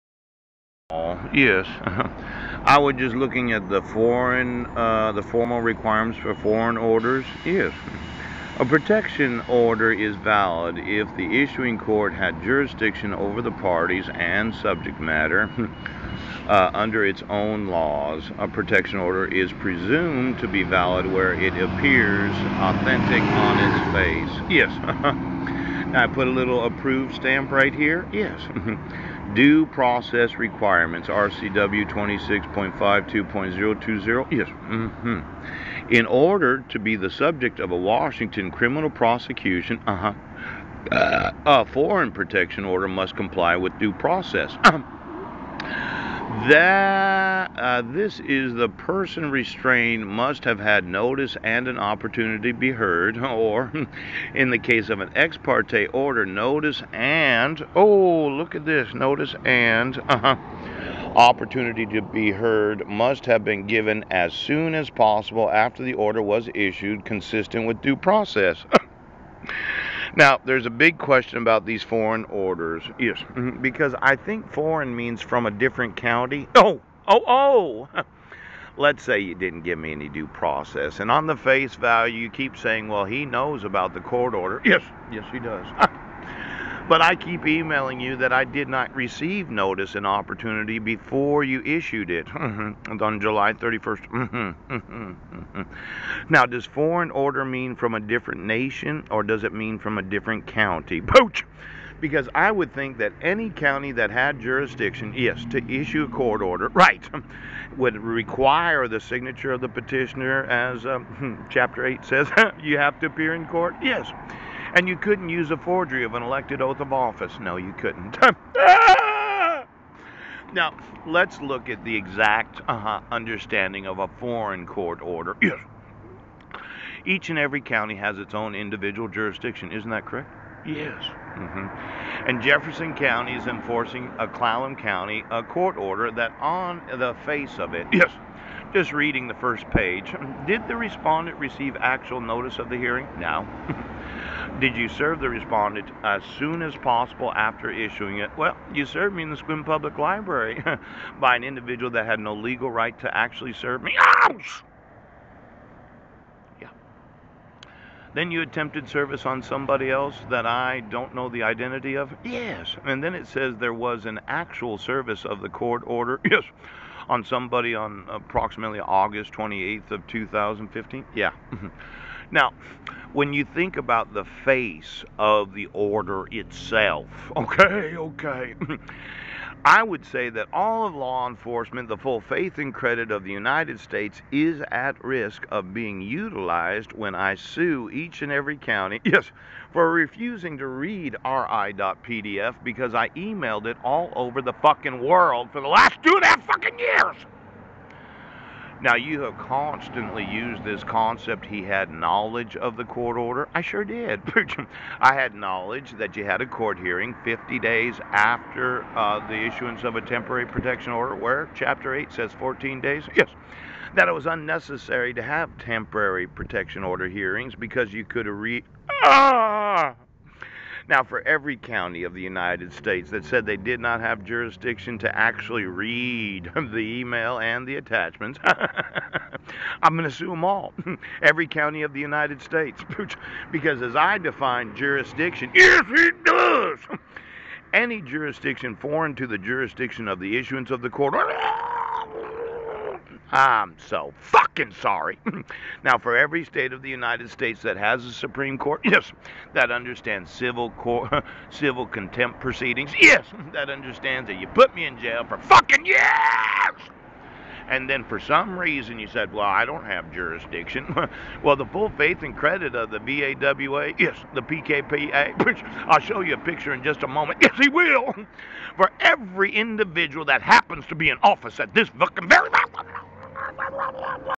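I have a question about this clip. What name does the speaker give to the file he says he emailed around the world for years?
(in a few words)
RI.pdf.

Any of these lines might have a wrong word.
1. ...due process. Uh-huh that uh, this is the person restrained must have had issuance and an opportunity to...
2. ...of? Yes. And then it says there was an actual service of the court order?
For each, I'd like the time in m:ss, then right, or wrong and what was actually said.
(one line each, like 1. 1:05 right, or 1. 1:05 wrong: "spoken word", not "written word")
1. 0:43 wrong: "notice", not "issuance"
2. 2:41 right.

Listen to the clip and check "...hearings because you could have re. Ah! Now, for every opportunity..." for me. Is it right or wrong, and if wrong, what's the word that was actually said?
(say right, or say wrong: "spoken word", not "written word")
wrong: "county", not "opportunity".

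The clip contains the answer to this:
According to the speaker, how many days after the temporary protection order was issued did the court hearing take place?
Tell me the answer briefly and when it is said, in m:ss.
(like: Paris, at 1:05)
50 days, at 3:27.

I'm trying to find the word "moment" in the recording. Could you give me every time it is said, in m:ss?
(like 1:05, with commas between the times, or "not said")
4:27, 4:32.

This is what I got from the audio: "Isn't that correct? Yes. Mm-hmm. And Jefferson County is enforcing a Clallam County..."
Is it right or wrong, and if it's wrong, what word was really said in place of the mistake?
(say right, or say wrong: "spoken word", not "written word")
right.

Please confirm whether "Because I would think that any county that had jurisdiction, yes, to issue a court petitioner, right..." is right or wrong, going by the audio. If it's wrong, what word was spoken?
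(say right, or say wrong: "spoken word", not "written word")
wrong: "order", not "petitioner".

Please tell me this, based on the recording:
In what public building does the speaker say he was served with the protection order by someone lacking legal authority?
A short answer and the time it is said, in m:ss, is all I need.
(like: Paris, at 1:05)
Sequim Public Library, at 2:29.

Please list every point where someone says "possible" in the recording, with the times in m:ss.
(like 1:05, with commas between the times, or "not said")
1:04, 2:26.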